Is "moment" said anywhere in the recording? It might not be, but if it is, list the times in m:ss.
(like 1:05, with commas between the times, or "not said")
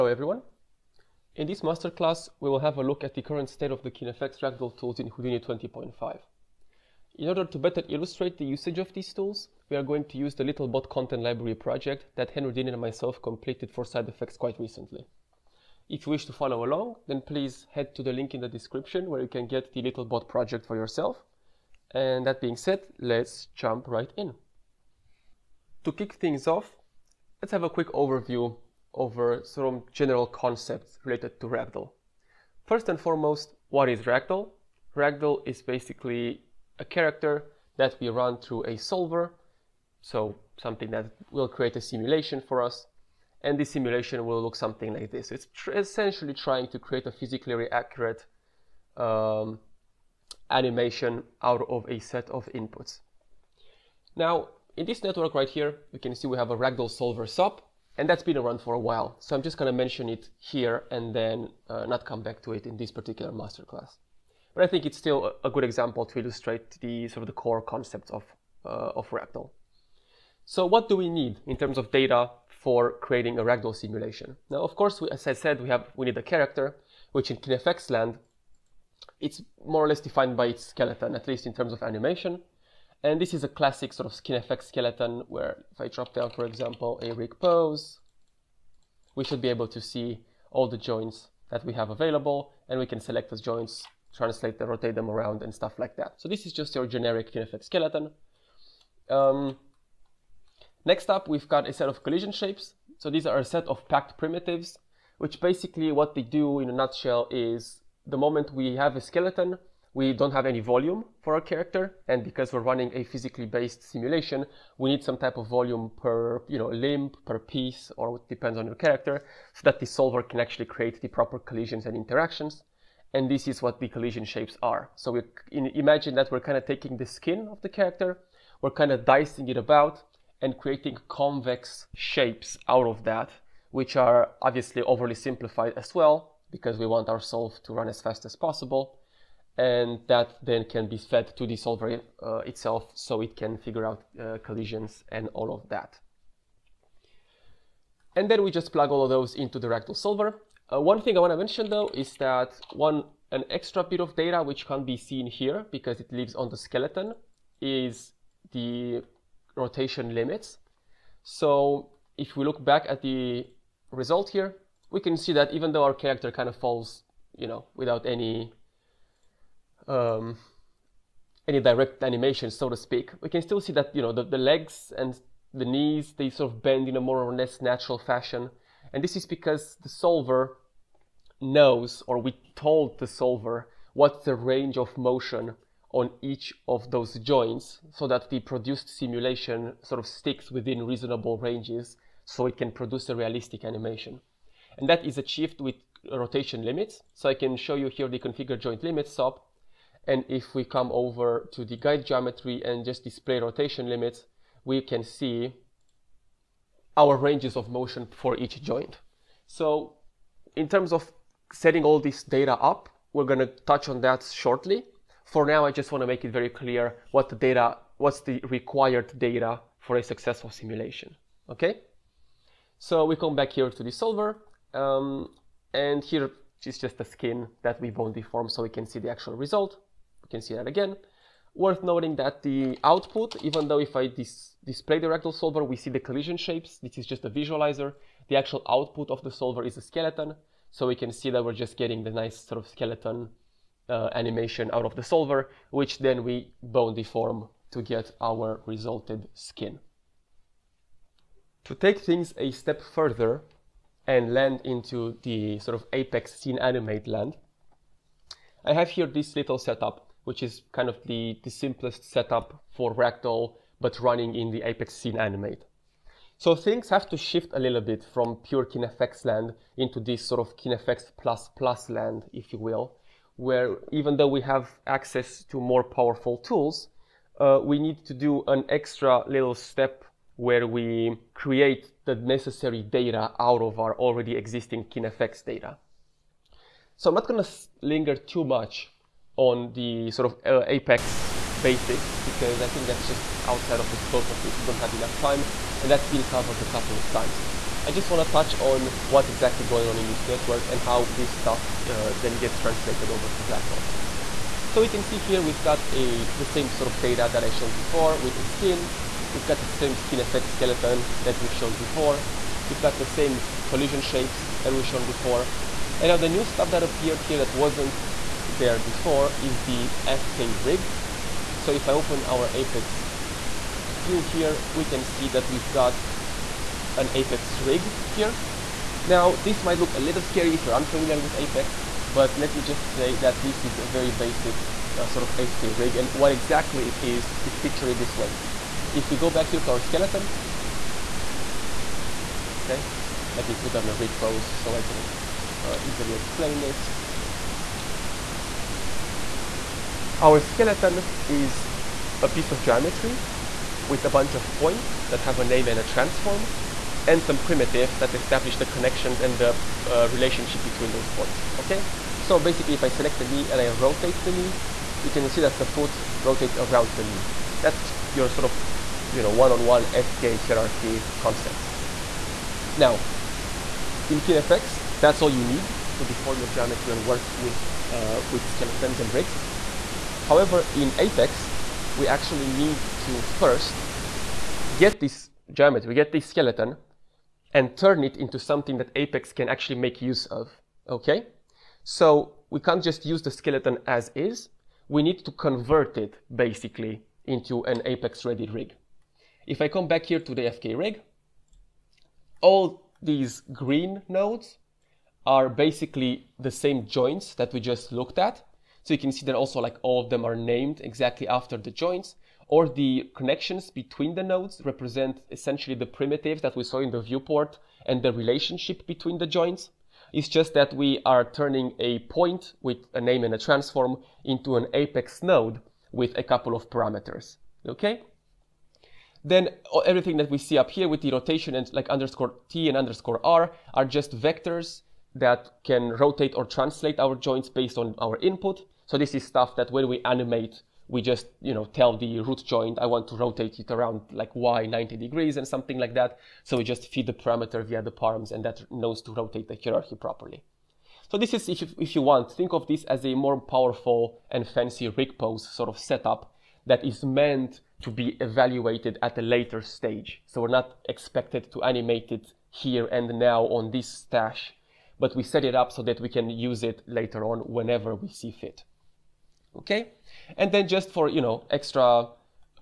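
1:48.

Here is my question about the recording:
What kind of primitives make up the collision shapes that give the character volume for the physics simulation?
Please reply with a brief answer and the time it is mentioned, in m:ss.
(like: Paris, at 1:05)
packed primitives, at 1:43.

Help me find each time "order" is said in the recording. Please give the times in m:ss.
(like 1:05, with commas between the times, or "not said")
0:07.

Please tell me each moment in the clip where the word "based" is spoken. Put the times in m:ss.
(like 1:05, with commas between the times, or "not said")
1:53, 7:17.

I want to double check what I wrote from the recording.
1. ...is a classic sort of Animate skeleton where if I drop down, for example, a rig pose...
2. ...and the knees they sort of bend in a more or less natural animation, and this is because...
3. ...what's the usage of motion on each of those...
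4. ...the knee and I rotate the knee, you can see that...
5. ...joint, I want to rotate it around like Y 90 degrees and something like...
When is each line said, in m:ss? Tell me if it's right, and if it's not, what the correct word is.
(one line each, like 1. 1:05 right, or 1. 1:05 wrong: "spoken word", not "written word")
1. 1:23 wrong: "KineFX", not "Animate"
2. 2:54 wrong: "fashion", not "animation"
3. 3:03 wrong: "range", not "usage"
4. 6:03 right
5. 7:22 right.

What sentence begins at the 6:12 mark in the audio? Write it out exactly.
Now, in KineFX, that's all you need to deform your geometry and work with, uh, with skeletons and rigs.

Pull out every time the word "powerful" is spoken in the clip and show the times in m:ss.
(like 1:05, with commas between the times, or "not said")
4:35, 7:33.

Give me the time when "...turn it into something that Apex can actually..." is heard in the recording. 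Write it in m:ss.
6:27.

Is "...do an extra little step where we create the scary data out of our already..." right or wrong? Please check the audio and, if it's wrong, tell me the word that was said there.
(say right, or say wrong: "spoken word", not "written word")
wrong: "necessary", not "scary".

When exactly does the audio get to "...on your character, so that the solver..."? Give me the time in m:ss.
1:58.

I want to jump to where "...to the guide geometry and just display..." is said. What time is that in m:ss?
3:21.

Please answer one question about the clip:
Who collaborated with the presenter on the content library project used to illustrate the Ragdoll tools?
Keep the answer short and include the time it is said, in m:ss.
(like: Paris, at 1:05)
Henry Dean, at 0:12.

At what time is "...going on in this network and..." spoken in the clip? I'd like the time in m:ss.
4:59.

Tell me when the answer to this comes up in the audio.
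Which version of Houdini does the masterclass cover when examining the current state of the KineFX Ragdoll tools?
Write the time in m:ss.
0:05.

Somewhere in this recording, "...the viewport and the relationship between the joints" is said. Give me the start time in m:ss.
6:56.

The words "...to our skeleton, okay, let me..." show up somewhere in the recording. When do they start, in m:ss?
5:39.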